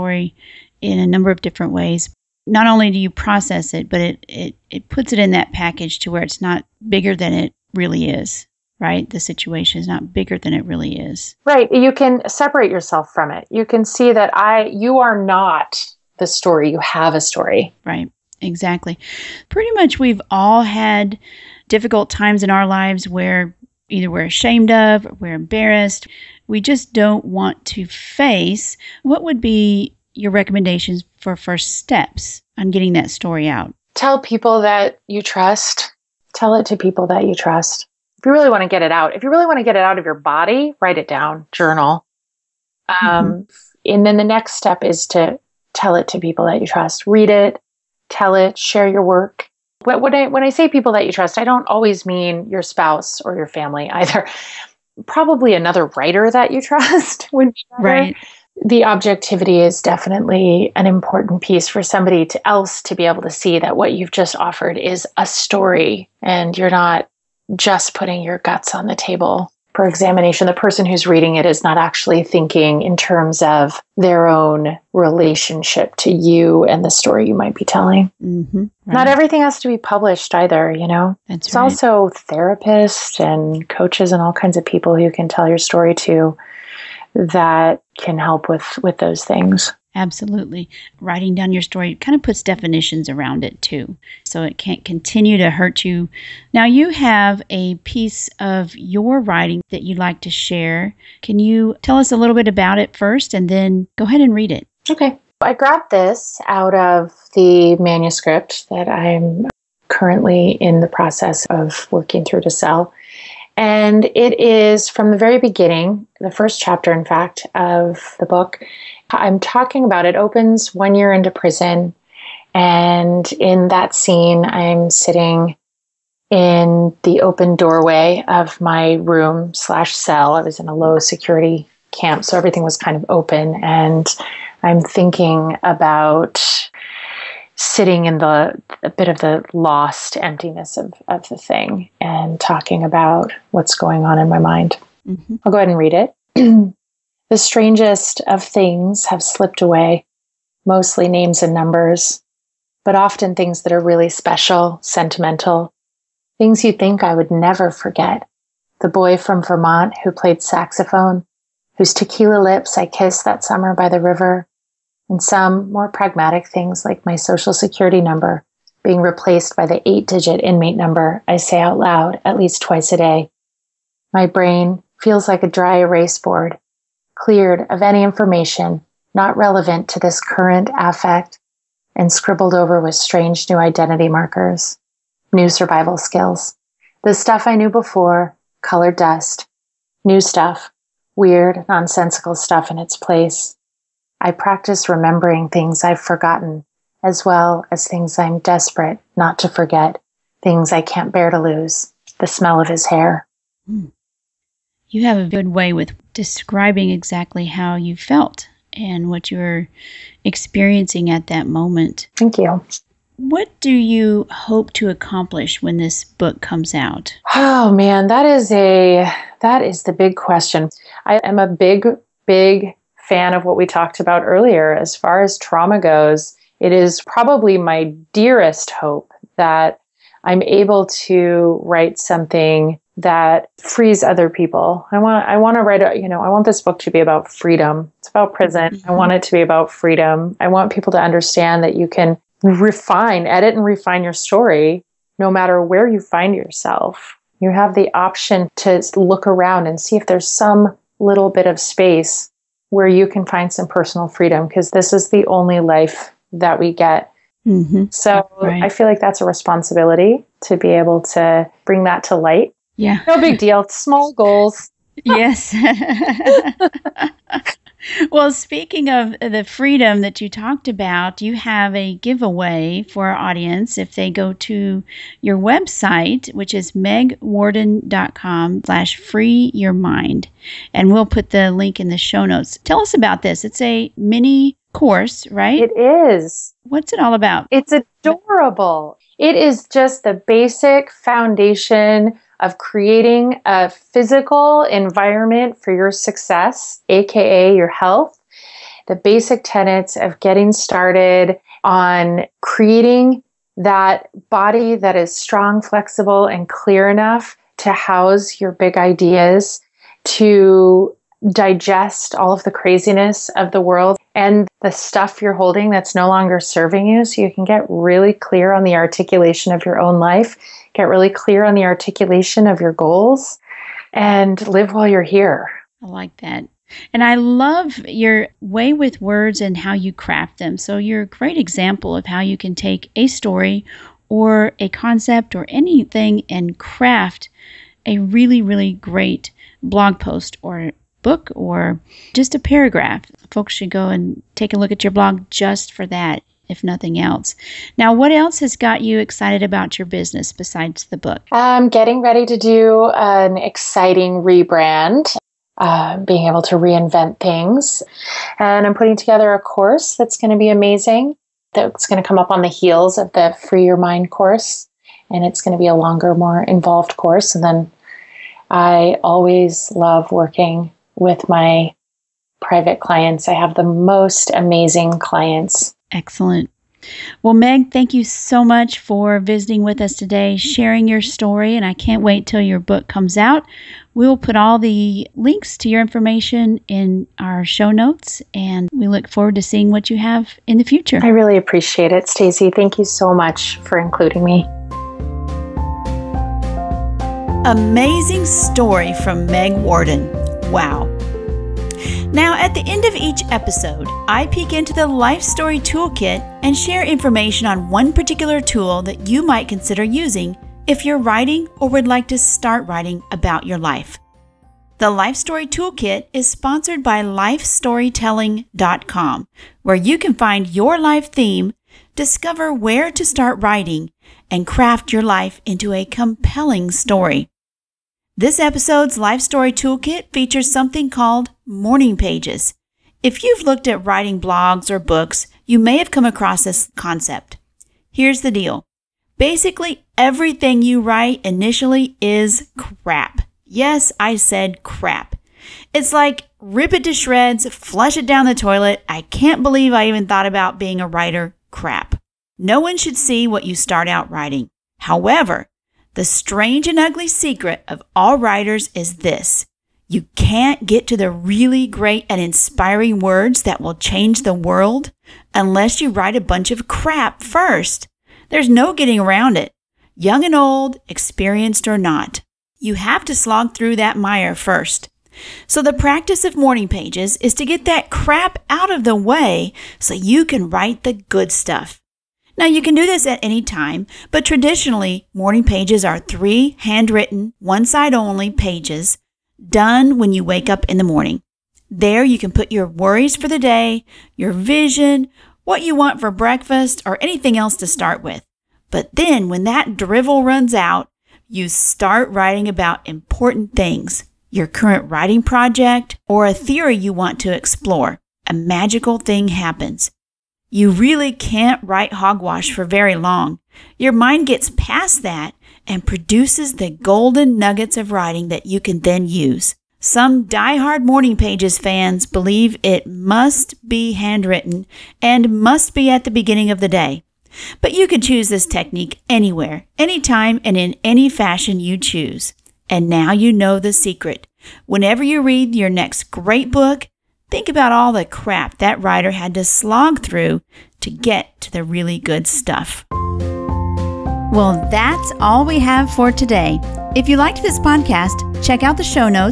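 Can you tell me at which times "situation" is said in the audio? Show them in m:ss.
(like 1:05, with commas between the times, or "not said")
0:09.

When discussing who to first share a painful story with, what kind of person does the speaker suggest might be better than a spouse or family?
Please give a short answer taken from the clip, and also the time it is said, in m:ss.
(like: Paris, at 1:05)
Another writer, at 0:55.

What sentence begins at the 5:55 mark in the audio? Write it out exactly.
Uh, being able to reinvent things.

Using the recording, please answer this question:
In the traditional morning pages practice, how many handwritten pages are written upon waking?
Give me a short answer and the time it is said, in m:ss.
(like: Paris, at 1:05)
3, at 8:05.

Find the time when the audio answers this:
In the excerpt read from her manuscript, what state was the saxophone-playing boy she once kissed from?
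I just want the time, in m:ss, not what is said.
2:39.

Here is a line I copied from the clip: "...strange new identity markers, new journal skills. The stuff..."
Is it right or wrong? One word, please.
wrong.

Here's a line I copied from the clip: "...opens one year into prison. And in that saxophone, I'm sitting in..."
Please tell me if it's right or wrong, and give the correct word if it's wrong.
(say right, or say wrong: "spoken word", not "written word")
wrong: "scene", not "saxophone".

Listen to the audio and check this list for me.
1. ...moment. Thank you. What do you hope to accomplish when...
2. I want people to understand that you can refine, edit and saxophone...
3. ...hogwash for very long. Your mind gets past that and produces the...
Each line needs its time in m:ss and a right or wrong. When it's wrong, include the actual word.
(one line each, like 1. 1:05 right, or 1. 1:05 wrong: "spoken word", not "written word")
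1. 3:31 right
2. 4:00 wrong: "refine", not "saxophone"
3. 8:31 right.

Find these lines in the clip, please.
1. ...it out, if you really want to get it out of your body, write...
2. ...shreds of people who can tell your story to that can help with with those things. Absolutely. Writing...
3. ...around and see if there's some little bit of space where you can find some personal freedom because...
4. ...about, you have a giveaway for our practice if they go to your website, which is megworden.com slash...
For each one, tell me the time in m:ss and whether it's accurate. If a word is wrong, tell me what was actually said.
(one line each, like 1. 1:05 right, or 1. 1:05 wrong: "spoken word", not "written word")
1. 0:38 right
2. 1:24 wrong: "kinds", not "shreds"
3. 4:09 right
4. 4:30 wrong: "audience", not "practice".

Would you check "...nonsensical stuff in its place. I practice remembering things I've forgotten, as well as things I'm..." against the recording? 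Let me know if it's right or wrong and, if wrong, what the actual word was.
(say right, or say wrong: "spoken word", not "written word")
right.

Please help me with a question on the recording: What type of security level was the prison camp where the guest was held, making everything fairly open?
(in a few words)
Low security.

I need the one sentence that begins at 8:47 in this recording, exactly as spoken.
But you can choose this technique anywhere, anytime, and in any fashion you choose.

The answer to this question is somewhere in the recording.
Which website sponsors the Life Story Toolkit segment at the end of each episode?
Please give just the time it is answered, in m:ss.
6:57.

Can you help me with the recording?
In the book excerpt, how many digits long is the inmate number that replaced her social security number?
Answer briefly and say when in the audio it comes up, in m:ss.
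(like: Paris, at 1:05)
8, at 2:49.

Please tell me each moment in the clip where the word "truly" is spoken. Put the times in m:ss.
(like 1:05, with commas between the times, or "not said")
not said.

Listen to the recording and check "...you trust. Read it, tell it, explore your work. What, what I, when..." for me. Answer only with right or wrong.
wrong.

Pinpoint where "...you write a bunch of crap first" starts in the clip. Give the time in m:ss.
7:45.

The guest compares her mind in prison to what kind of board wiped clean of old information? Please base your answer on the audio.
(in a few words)
Dry erase board.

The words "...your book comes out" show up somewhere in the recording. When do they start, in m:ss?
6:22.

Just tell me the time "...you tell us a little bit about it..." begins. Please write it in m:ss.
1:41.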